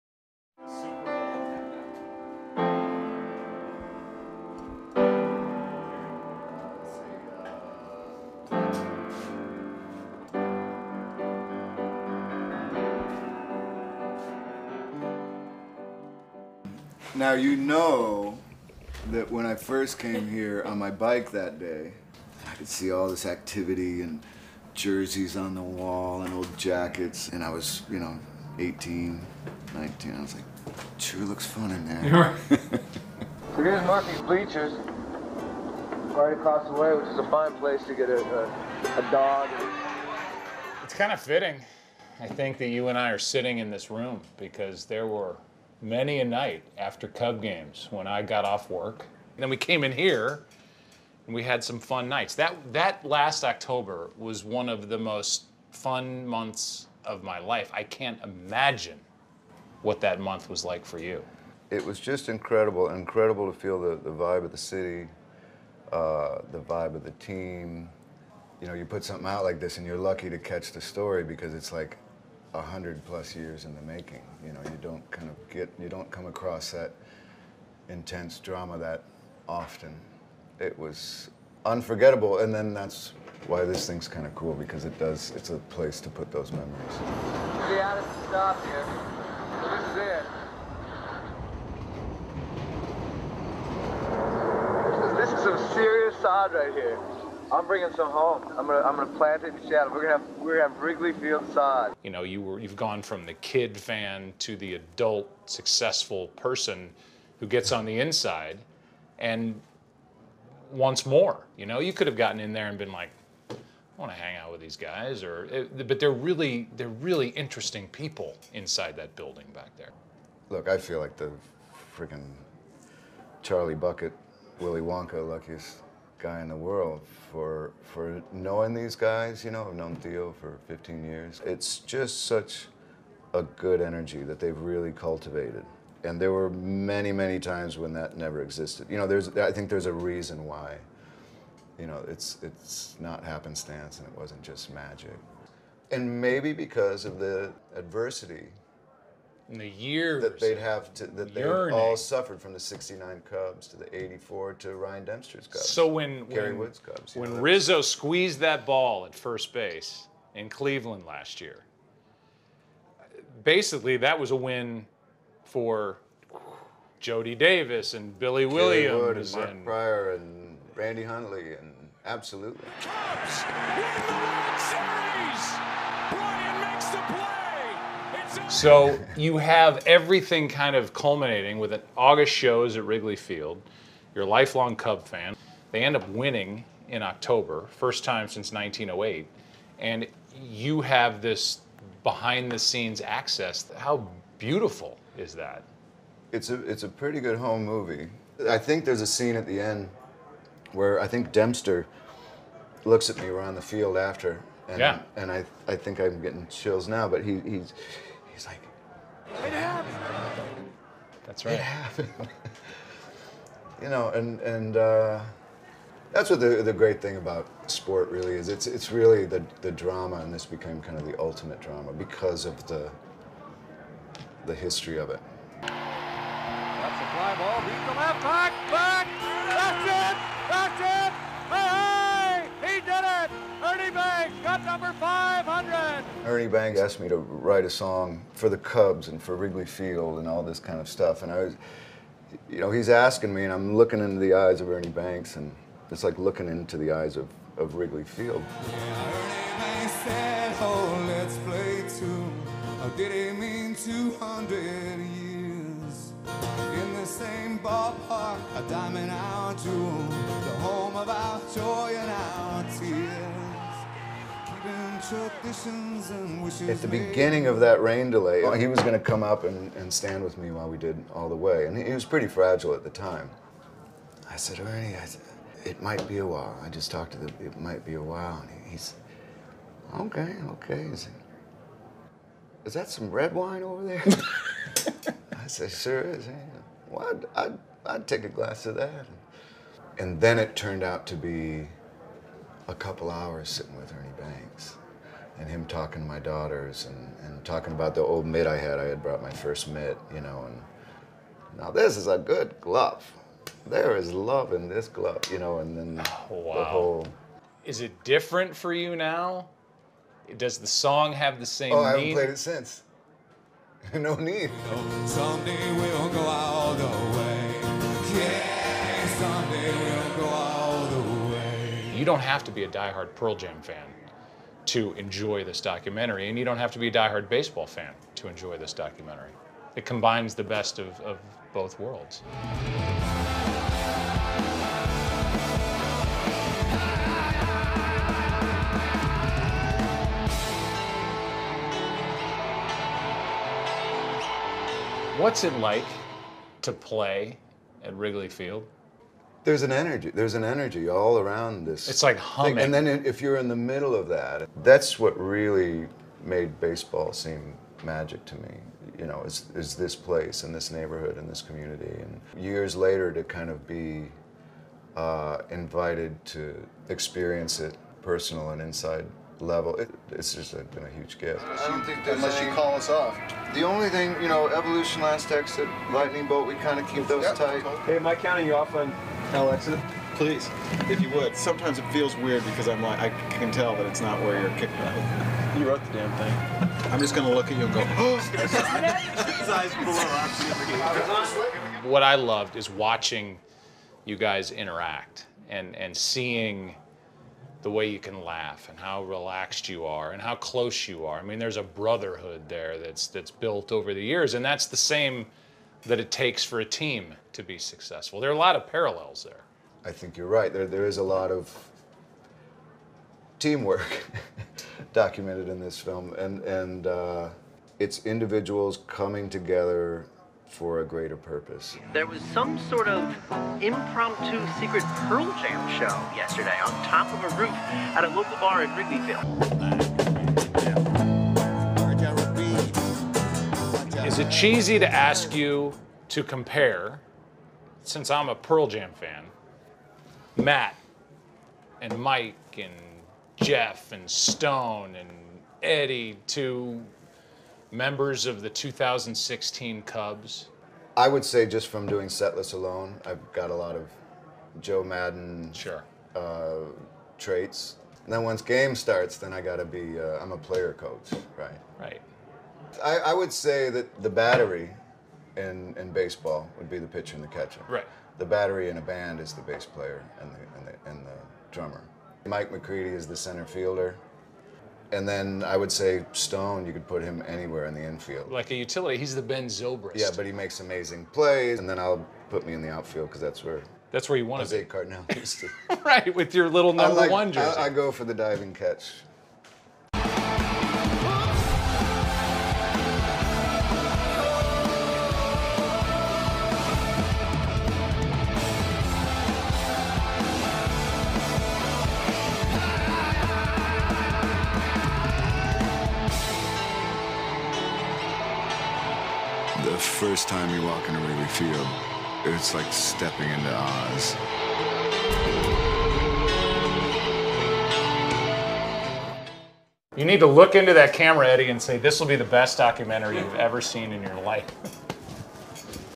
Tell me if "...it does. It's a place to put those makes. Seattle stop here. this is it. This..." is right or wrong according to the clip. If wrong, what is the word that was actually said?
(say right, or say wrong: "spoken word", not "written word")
wrong: "memories", not "makes".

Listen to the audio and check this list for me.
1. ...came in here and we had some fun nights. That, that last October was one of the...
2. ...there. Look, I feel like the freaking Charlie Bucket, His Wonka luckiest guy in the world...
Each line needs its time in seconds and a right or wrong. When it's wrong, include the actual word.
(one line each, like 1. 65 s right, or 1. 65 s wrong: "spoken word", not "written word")
1. 49 s right
2. 119 s wrong: "Willy", not "His".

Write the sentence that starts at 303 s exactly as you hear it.
There is love in this glove, you know, and then oh, wow.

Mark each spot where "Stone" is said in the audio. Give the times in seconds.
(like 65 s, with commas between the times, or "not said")
444 s, 476 s.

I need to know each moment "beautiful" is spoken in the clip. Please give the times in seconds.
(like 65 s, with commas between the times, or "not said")
194 s.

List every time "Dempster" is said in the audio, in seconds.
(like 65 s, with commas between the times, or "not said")
155 s, 201 s.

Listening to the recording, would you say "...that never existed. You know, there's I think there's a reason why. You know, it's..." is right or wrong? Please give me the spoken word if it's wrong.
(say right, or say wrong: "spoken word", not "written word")
right.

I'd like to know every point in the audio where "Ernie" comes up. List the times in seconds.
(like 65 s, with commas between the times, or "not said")
236 s, 244 s, 274 s, 293 s.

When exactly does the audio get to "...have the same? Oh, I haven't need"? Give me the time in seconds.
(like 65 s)
311 s.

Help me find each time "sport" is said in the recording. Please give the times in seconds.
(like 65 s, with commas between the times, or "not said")
217 s.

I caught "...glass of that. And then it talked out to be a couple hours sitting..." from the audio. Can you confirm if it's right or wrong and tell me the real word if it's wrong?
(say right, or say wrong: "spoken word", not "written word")
wrong: "turned", not "talked".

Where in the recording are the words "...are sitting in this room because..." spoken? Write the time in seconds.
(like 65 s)
43 s.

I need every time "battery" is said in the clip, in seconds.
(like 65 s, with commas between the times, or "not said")
464 s, 468 s.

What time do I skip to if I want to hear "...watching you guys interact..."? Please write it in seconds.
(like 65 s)
392 s.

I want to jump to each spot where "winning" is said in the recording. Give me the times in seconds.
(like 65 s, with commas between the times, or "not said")
186 s.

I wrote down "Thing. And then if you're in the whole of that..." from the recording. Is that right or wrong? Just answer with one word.
wrong.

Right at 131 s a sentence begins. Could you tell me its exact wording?
It's just such a good energy that they've really cultivated.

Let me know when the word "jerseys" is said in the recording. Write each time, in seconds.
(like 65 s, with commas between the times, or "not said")
24 s, 487 s.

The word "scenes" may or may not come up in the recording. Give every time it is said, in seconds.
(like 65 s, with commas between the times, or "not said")
192 s, 199 s.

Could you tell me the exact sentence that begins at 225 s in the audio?
That's a fly ball deep the left back.